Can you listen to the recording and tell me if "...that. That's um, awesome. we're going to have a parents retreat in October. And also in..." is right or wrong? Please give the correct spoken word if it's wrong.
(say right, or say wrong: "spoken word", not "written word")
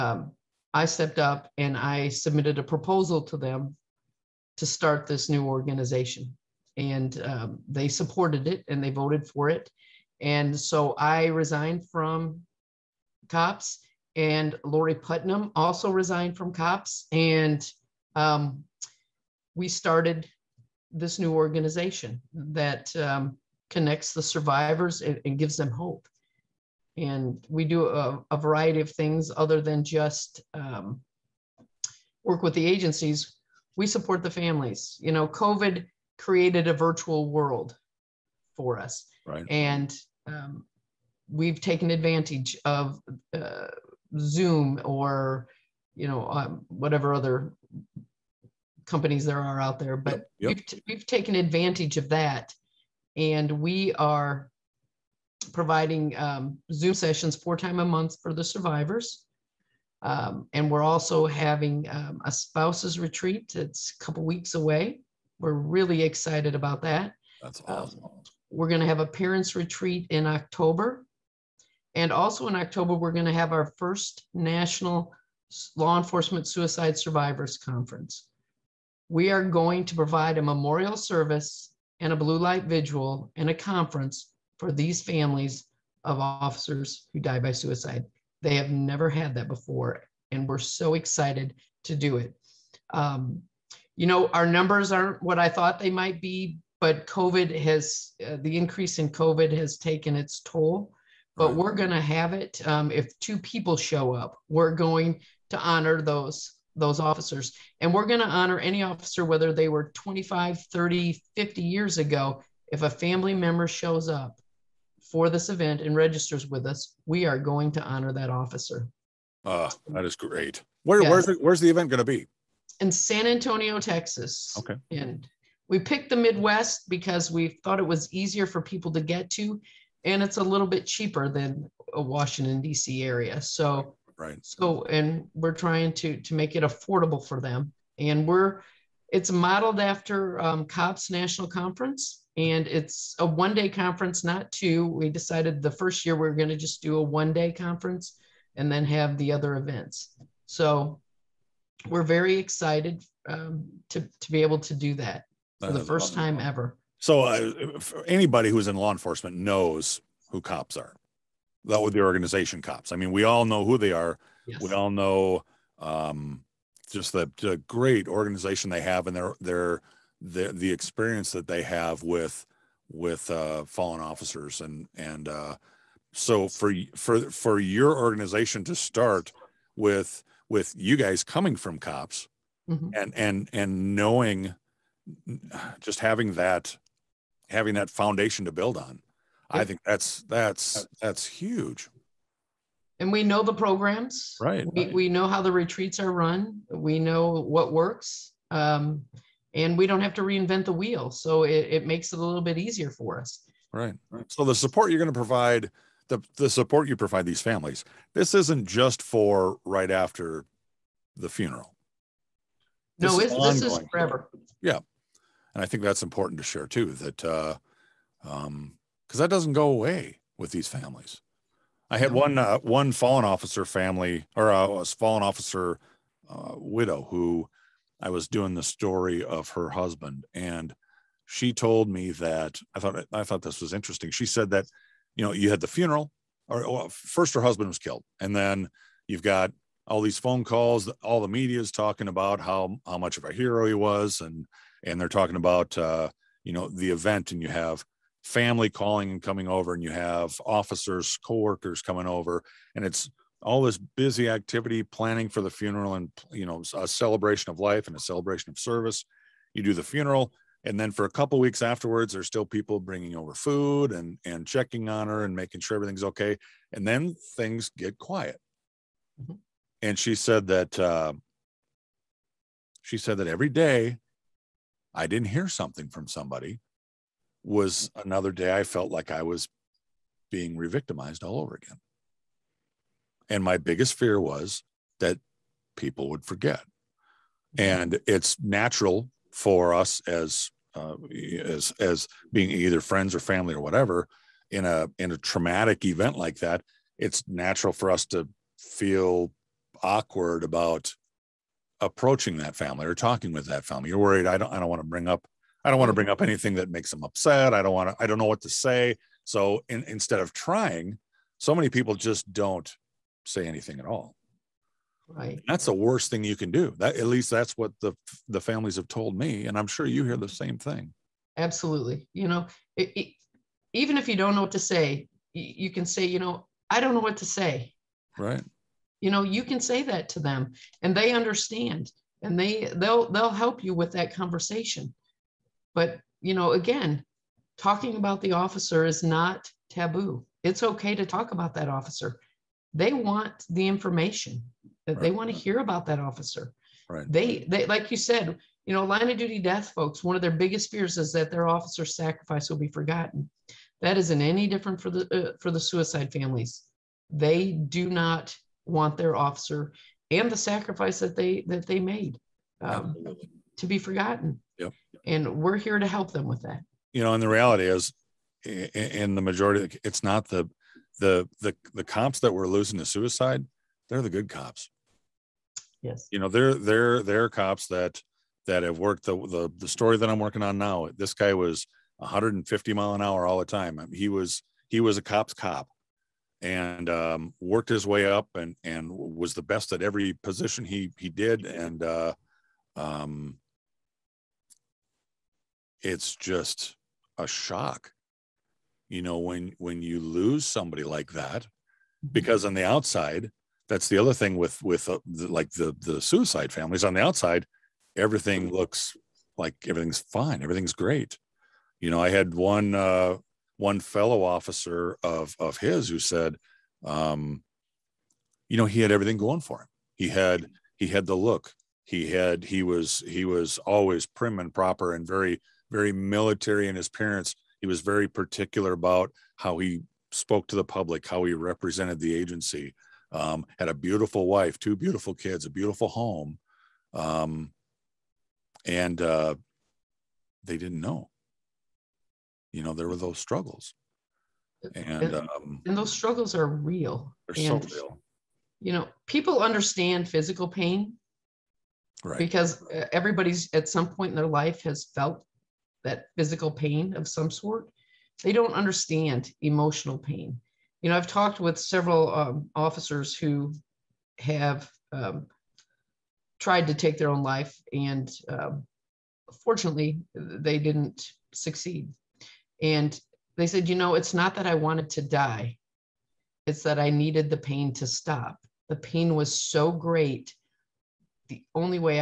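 right.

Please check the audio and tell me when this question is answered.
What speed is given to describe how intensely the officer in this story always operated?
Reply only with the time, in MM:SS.
06:21.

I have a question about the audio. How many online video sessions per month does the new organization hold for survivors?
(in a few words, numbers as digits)
4.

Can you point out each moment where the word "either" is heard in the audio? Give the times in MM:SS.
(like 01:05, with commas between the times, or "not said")
04:52.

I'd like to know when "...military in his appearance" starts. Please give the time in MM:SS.
07:05.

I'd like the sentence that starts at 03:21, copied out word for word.
So it, it makes it a little bit easier for us.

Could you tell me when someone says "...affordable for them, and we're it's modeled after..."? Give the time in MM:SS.
02:16.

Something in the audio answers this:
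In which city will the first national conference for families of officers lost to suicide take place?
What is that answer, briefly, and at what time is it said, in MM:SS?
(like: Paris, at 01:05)
San Antonio, Texas, at 02:02.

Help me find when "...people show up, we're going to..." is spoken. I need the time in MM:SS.
01:43.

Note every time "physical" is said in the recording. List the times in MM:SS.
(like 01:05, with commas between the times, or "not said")
07:30, 07:36.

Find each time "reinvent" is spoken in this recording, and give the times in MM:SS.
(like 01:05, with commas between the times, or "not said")
03:20.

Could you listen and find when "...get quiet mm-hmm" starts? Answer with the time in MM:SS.
04:27.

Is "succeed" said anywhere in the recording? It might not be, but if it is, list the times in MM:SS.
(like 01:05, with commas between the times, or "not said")
07:51.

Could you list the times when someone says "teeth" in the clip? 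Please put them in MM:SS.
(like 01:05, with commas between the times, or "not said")
not said.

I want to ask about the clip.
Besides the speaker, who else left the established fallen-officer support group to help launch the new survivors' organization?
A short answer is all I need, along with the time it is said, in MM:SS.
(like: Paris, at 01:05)
Lori Putnam, at 00:14.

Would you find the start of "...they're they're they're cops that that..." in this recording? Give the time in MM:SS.
06:16.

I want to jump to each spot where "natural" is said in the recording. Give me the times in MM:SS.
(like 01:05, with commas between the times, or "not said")
04:48, 04:57.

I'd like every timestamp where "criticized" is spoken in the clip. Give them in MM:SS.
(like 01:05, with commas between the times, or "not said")
not said.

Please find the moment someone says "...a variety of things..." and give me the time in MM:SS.
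00:28.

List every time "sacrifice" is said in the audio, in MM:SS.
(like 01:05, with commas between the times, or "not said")
05:51, 06:00.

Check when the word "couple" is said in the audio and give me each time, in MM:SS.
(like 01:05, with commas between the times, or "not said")
01:04, 04:21.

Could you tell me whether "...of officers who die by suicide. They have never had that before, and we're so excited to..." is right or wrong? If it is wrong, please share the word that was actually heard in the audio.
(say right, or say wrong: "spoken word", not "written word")
right.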